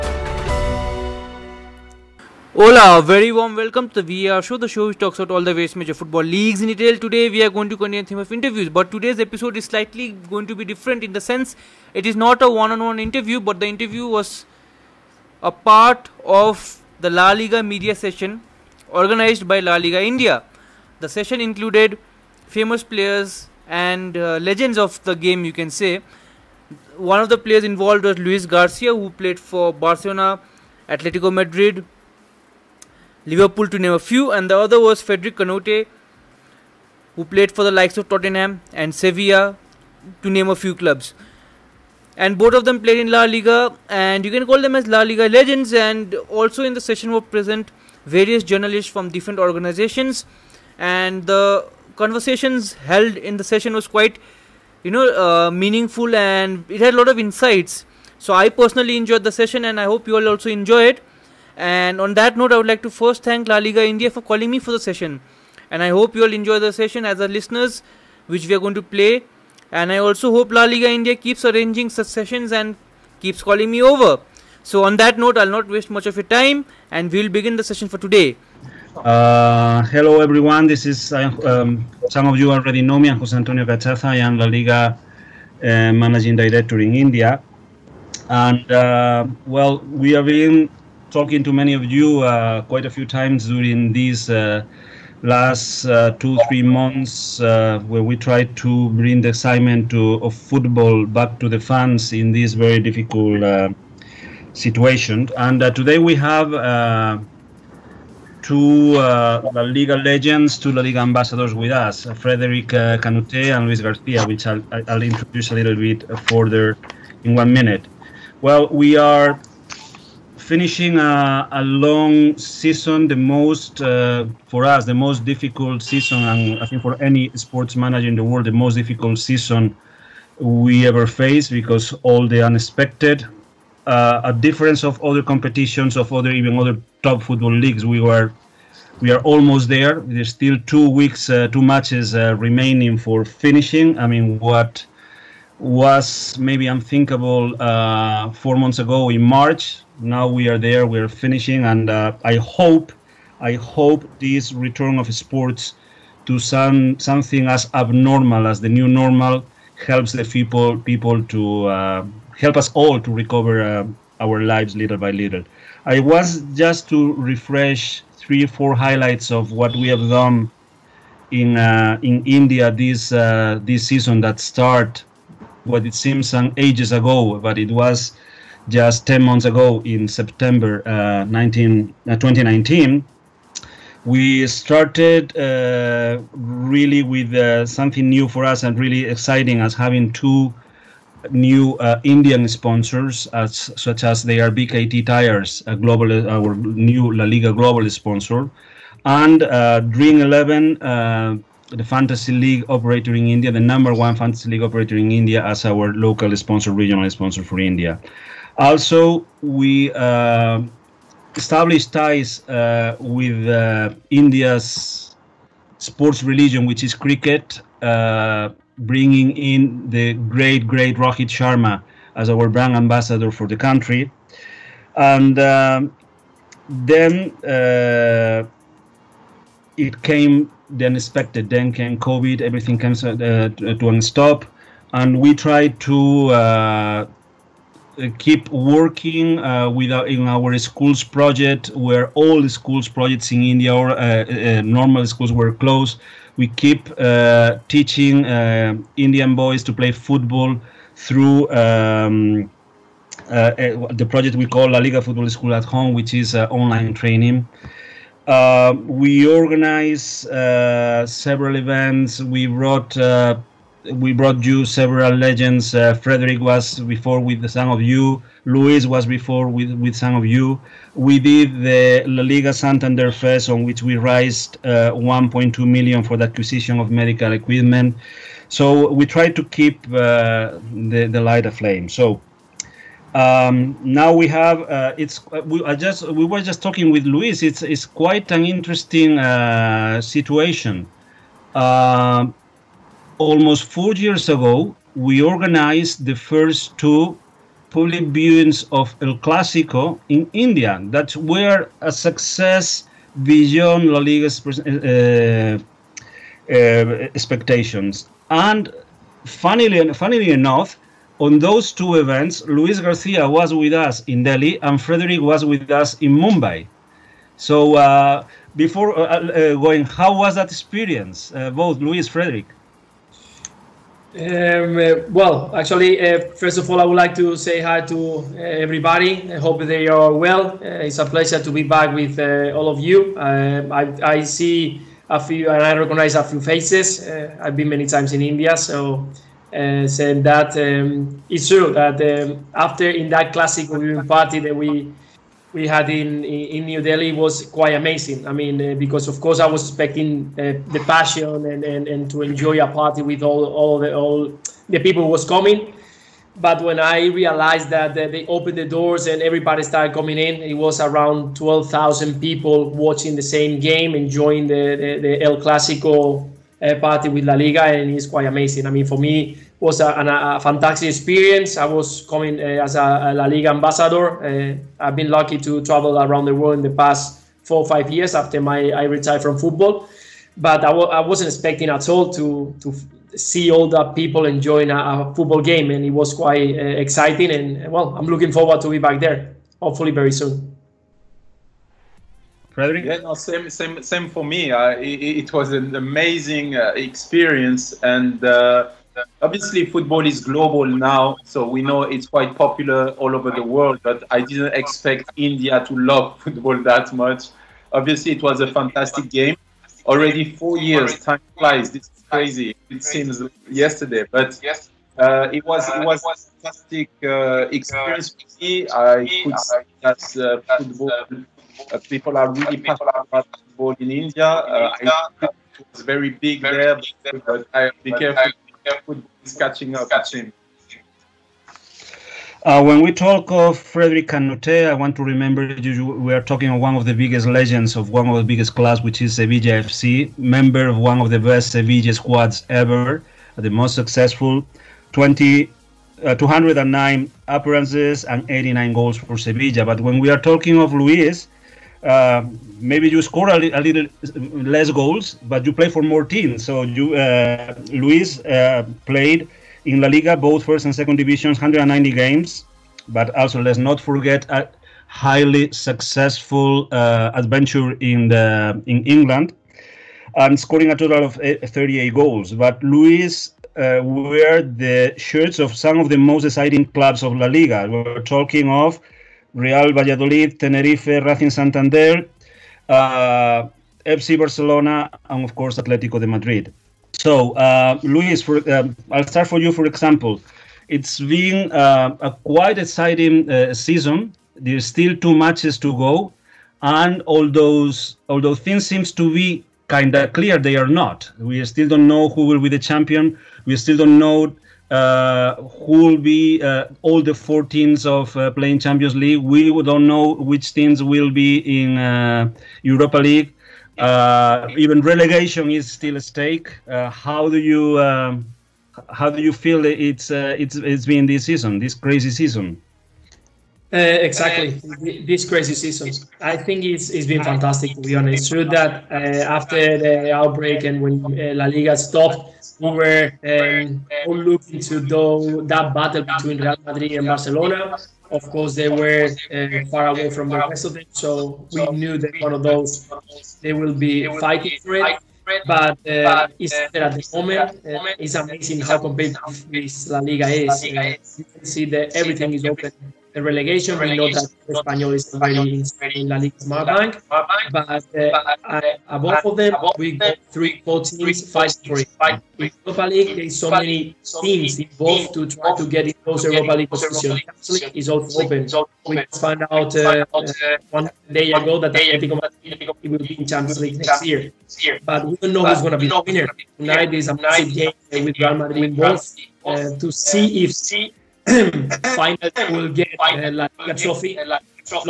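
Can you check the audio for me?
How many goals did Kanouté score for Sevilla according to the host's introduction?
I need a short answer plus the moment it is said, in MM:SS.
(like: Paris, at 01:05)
89, at 07:28.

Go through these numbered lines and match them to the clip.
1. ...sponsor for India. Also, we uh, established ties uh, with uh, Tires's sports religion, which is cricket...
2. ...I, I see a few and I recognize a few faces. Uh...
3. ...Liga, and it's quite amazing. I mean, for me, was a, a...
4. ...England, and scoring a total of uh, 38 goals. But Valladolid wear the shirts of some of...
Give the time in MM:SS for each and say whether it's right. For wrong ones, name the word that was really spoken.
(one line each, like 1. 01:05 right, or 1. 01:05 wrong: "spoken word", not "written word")
1. 03:27 wrong: "India", not "Tires"
2. 05:33 right
3. 06:07 right
4. 07:48 wrong: "Luis", not "Valladolid".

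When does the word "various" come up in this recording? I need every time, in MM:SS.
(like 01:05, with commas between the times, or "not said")
00:05, 00:48.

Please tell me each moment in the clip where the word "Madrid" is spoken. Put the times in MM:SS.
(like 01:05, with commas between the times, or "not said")
00:31, 08:06, 08:56, 09:32, 09:38.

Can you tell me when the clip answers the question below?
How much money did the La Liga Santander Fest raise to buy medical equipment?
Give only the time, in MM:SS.
04:34.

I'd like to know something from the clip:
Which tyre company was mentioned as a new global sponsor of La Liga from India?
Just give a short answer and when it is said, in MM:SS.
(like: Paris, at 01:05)
BKT Tires, at 03:14.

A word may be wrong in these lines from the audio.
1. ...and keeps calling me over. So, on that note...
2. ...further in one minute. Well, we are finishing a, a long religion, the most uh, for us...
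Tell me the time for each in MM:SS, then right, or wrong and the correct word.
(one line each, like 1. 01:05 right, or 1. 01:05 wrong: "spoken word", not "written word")
1. 01:12 right
2. 01:56 wrong: "season", not "religion".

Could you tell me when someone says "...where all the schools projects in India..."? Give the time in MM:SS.
04:01.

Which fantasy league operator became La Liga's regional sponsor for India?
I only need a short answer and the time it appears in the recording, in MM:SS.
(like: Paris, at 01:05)
Dream Eleven, at 03:19.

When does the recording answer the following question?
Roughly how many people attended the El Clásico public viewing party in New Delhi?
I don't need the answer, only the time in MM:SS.
06:01.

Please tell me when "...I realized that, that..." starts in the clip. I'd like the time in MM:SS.
05:56.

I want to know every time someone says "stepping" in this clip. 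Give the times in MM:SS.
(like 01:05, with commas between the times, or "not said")
not said.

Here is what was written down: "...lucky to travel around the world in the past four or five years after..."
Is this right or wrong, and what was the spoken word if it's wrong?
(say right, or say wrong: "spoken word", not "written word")
right.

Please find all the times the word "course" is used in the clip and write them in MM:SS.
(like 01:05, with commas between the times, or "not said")
05:49, 08:05, 08:58.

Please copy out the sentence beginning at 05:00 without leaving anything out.
That were a success beyond La Liga's uh, uh, expectations.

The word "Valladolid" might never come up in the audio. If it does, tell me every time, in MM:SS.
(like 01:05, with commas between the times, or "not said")
07:59.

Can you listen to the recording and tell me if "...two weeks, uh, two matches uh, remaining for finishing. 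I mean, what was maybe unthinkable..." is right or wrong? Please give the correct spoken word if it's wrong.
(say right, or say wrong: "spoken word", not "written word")
right.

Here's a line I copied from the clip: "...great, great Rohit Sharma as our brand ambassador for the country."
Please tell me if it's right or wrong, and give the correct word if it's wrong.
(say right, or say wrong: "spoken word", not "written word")
right.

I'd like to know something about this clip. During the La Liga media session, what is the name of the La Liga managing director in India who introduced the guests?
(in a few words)
Jose Antonio Cachaza.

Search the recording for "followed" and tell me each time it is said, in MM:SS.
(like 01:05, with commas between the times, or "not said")
not said.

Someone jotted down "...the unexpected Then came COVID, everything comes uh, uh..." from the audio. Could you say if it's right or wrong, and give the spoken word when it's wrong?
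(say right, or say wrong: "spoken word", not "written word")
right.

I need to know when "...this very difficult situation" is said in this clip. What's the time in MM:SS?
01:42.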